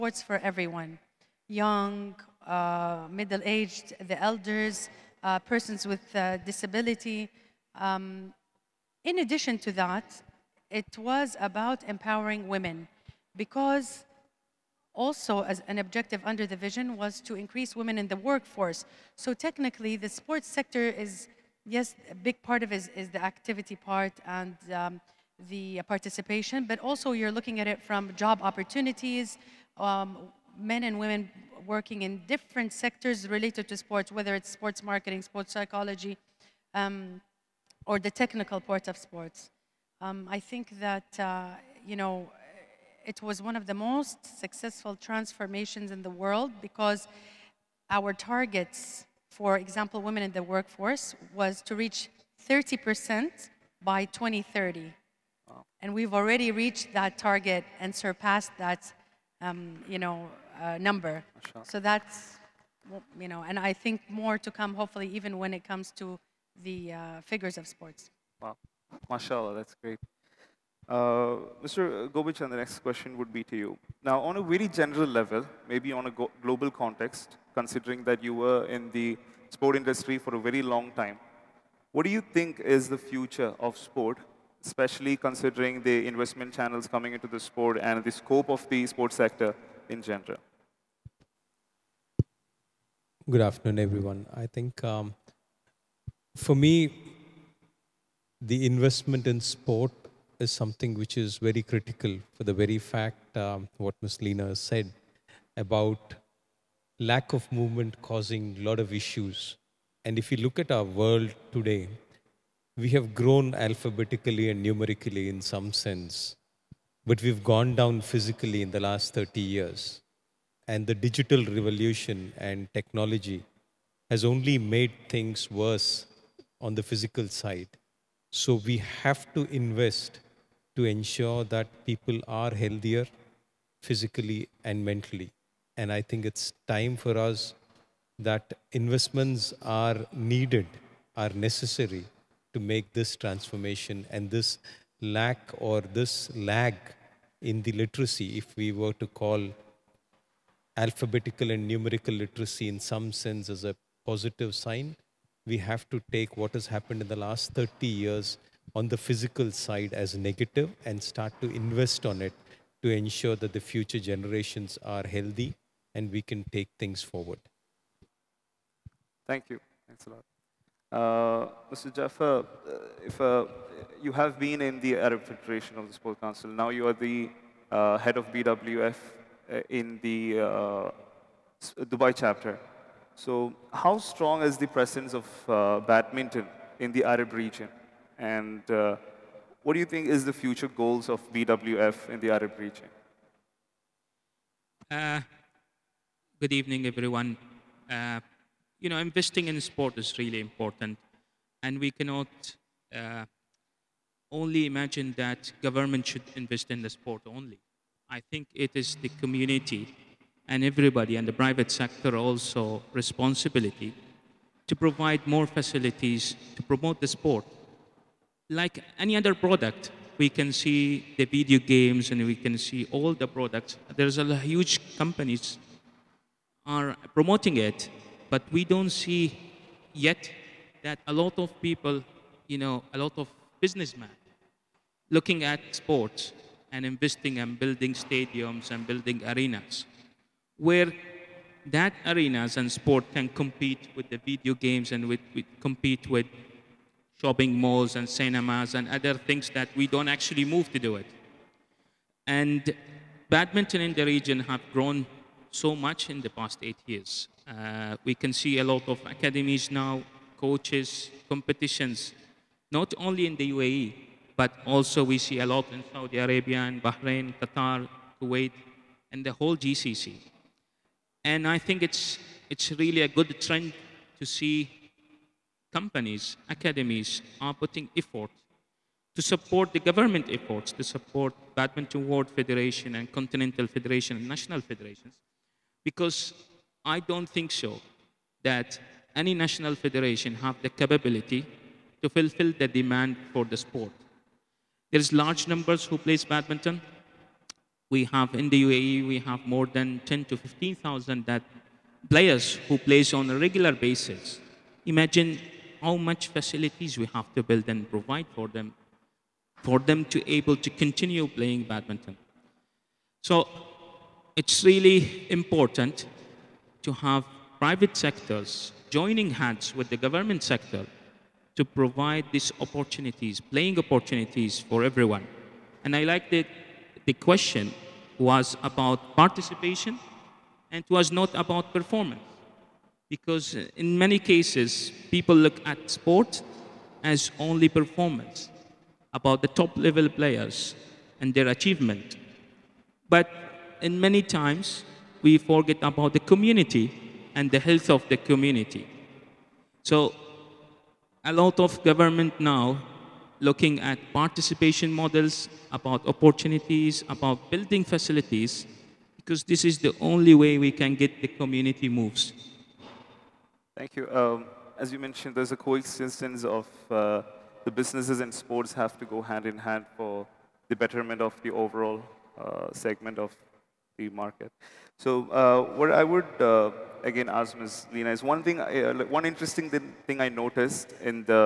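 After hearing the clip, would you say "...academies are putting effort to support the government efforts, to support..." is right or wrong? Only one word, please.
right.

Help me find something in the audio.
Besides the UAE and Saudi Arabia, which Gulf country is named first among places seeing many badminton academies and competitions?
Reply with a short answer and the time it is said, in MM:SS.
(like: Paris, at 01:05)
Bahrain, at 04:26.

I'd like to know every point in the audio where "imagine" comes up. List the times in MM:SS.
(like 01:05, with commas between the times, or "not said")
03:24, 05:04.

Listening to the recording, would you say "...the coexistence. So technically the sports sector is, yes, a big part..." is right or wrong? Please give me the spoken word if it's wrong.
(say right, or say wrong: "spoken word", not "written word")
wrong: "workforce", not "coexistence".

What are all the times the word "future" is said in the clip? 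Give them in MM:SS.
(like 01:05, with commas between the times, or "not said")
01:22, 02:43, 03:10.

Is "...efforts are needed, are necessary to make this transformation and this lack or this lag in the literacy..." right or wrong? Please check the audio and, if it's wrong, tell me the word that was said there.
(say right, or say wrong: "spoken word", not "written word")
wrong: "investments", not "efforts".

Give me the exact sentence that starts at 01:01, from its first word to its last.
So that's, you know, and I think more to come, hopefully, even when it comes to the uh, figures of sports.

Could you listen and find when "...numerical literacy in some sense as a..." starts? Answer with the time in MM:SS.
02:31.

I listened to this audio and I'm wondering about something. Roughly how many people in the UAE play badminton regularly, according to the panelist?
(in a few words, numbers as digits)
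10,000 to 15,000.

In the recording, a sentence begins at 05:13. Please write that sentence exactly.
So it's really important to have private sectors joining hands with the government sector to provide these opportunities, playing opportunities for everyone.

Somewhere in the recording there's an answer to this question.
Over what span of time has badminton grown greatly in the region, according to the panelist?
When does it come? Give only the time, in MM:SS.
04:16.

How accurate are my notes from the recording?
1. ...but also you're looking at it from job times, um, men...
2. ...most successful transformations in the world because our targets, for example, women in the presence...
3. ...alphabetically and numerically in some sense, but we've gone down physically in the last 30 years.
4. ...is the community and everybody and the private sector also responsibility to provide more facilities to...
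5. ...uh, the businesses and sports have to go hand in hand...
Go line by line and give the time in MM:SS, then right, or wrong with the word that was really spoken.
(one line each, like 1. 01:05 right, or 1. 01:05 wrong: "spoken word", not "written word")
1. 00:26 wrong: "opportunities", not "times"
2. 00:43 wrong: "workforce", not "presence"
3. 01:53 right
4. 03:28 right
5. 06:06 right.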